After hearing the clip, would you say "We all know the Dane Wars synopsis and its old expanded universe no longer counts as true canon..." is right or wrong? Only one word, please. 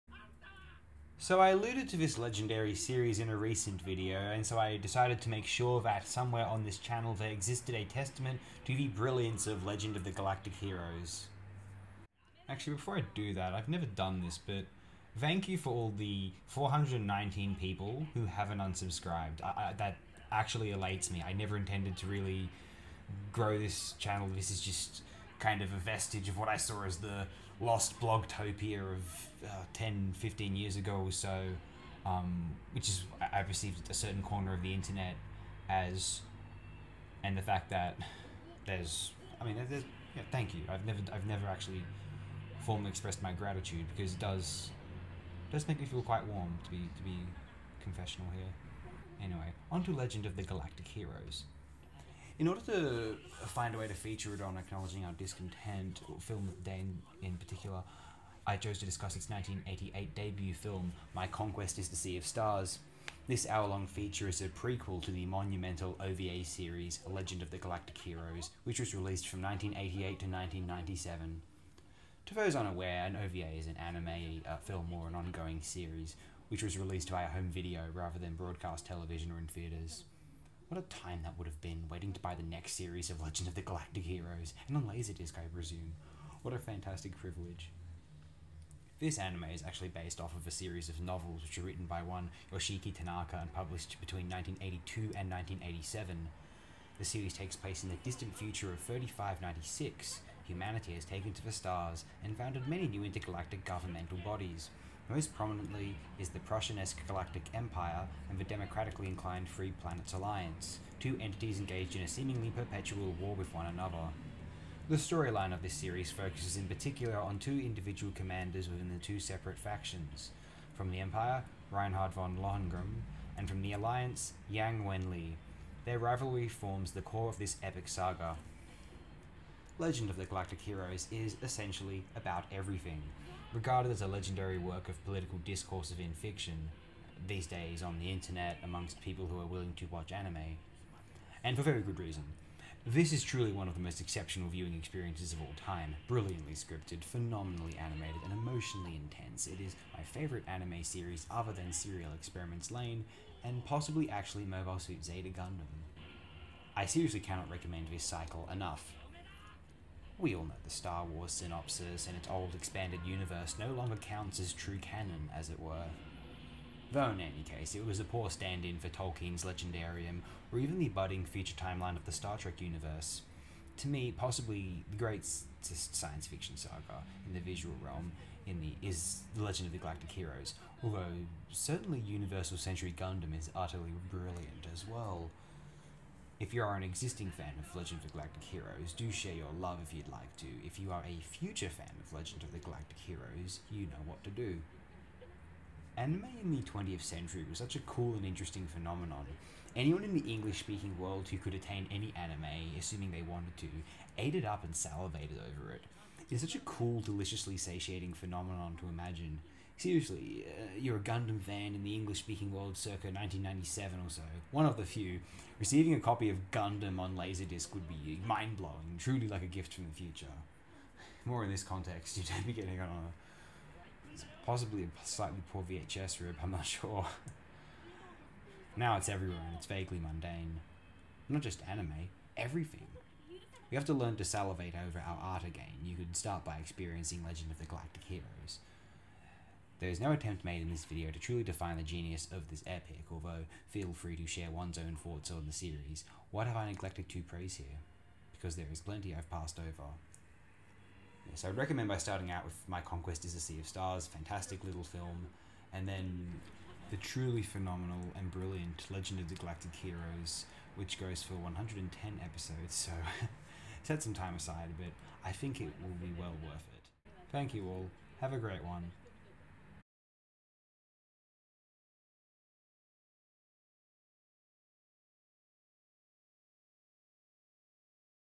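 wrong.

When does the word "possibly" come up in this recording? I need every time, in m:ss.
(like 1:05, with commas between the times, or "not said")
2:33, 2:54, 3:44.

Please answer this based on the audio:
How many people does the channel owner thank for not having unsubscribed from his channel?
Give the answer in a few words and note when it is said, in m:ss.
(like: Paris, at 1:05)
419, at 0:16.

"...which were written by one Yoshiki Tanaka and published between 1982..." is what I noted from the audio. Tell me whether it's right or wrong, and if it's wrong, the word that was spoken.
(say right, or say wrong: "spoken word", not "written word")
right.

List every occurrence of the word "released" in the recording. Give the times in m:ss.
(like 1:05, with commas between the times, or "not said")
1:08, 1:16.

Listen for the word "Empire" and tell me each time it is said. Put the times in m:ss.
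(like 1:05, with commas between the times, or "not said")
1:47, 2:01.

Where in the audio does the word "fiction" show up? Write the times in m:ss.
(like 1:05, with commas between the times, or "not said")
2:16, 2:56.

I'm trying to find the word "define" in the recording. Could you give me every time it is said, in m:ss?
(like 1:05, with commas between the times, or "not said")
4:01.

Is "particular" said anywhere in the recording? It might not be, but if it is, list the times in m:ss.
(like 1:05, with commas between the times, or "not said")
0:57, 1:56.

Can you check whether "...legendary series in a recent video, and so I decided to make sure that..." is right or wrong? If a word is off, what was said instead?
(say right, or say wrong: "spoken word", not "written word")
right.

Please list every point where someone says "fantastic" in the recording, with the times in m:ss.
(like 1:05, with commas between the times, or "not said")
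1:26, 4:14.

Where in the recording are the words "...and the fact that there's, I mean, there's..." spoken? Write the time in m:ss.
0:37.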